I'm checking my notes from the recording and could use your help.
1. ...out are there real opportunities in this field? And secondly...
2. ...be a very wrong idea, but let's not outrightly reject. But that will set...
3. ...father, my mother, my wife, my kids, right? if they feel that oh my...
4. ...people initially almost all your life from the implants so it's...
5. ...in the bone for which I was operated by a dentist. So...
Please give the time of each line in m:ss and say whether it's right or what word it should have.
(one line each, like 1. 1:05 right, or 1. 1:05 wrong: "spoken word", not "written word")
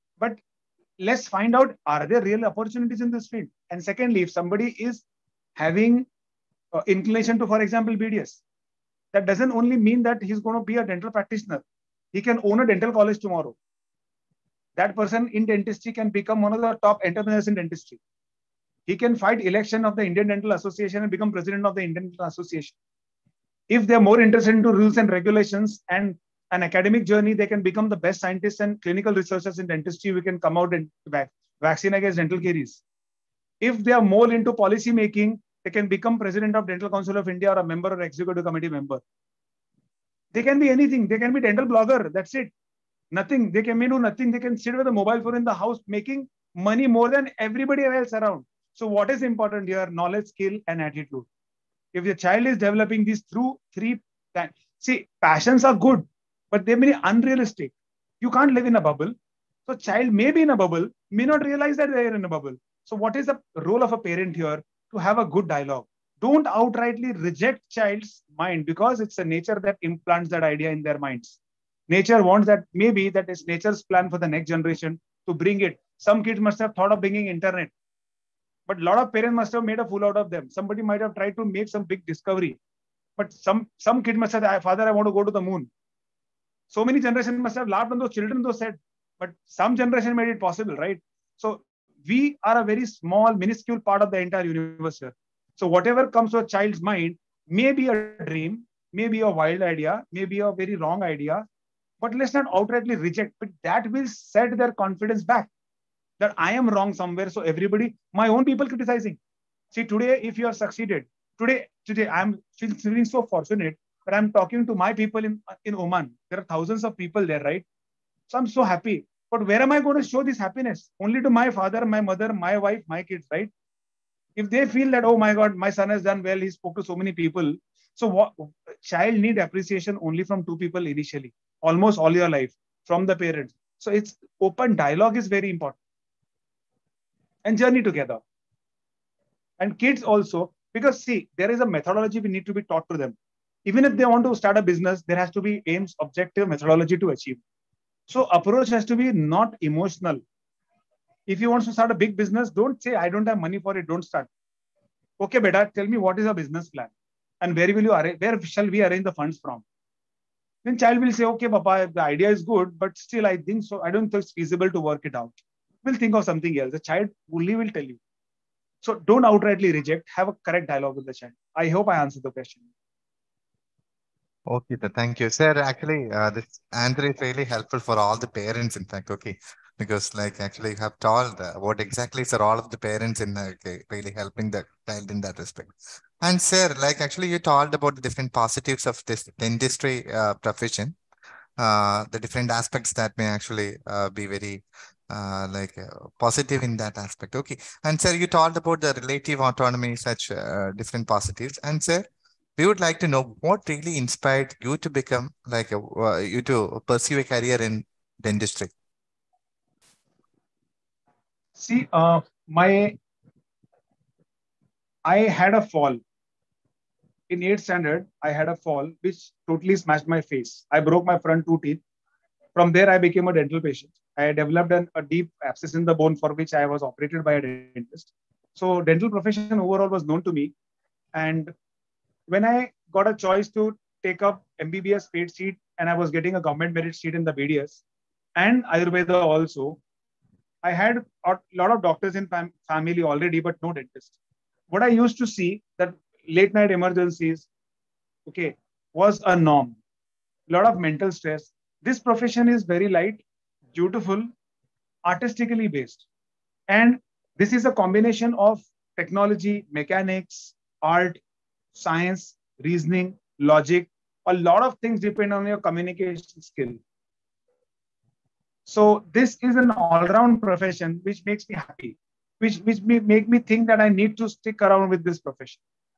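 1. 0:01 right
2. 1:40 right
3. 2:01 right
4. 2:10 wrong: "parents", not "implants"
5. 3:45 right.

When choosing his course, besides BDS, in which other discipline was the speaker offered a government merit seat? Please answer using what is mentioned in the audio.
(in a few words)
Ayurveda.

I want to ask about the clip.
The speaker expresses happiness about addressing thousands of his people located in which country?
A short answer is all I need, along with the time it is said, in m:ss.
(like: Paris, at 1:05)
Oman, at 1:55.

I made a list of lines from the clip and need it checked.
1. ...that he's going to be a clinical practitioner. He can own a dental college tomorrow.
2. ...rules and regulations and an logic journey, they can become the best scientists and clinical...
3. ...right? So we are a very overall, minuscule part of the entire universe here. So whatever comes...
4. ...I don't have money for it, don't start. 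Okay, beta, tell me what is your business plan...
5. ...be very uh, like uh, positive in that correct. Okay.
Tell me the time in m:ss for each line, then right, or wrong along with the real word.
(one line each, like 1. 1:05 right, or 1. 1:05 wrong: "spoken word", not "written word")
1. 0:10 wrong: "dental", not "clinical"
2. 0:24 wrong: "academic", not "logic"
3. 1:30 wrong: "small", not "overall"
4. 2:32 right
5. 3:14 wrong: "aspect", not "correct".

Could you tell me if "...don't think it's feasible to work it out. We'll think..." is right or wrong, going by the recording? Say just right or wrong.
right.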